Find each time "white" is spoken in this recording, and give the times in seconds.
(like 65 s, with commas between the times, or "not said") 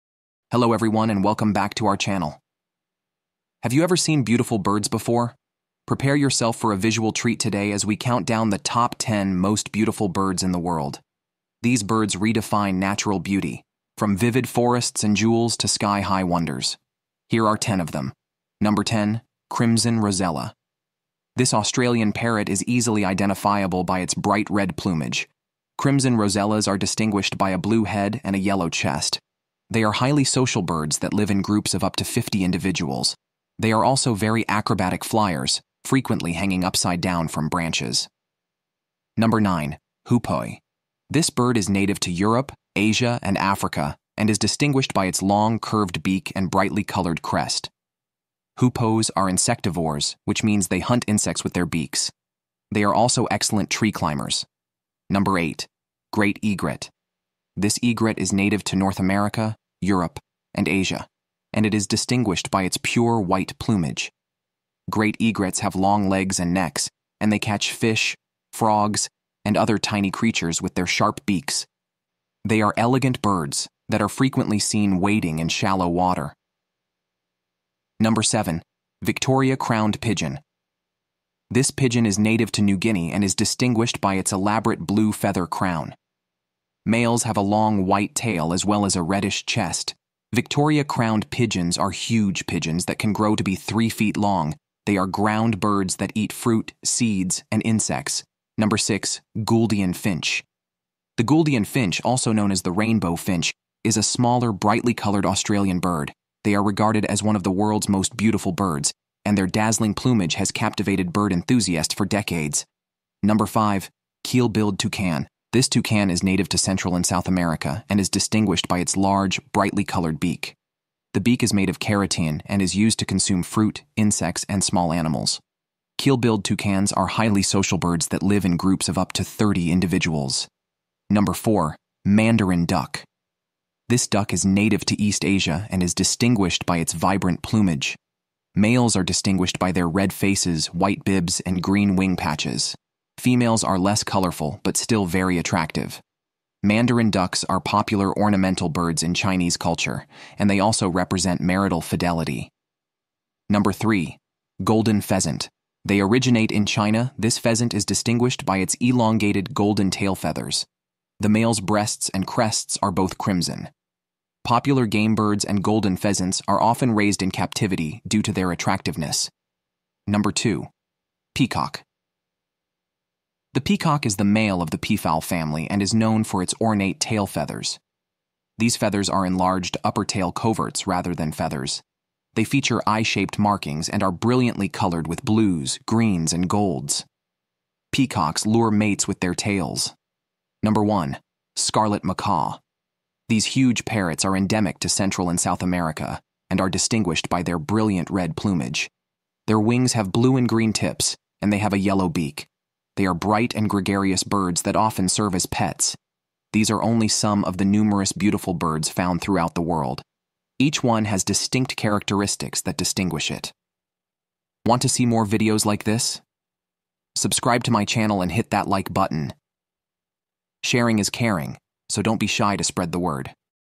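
63 s, 87 s, 140 s.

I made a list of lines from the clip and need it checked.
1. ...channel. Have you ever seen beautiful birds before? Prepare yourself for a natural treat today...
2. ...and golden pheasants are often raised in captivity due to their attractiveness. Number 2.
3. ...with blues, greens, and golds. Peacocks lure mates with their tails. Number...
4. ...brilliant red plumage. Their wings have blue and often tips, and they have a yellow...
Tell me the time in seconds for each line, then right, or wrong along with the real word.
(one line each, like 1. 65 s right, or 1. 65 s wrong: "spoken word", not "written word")
1. 1 s wrong: "visual", not "natural"
2. 165 s right
3. 185 s right
4. 197 s wrong: "green", not "often".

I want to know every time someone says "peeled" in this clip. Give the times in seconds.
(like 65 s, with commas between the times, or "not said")
not said.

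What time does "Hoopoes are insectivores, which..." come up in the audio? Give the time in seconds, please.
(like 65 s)
48 s.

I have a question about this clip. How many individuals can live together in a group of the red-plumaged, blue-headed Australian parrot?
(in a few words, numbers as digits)
50.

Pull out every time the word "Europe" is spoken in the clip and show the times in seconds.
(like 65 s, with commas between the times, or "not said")
42 s, 59 s.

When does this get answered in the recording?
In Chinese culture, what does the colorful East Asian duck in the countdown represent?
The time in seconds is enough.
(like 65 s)
151 s.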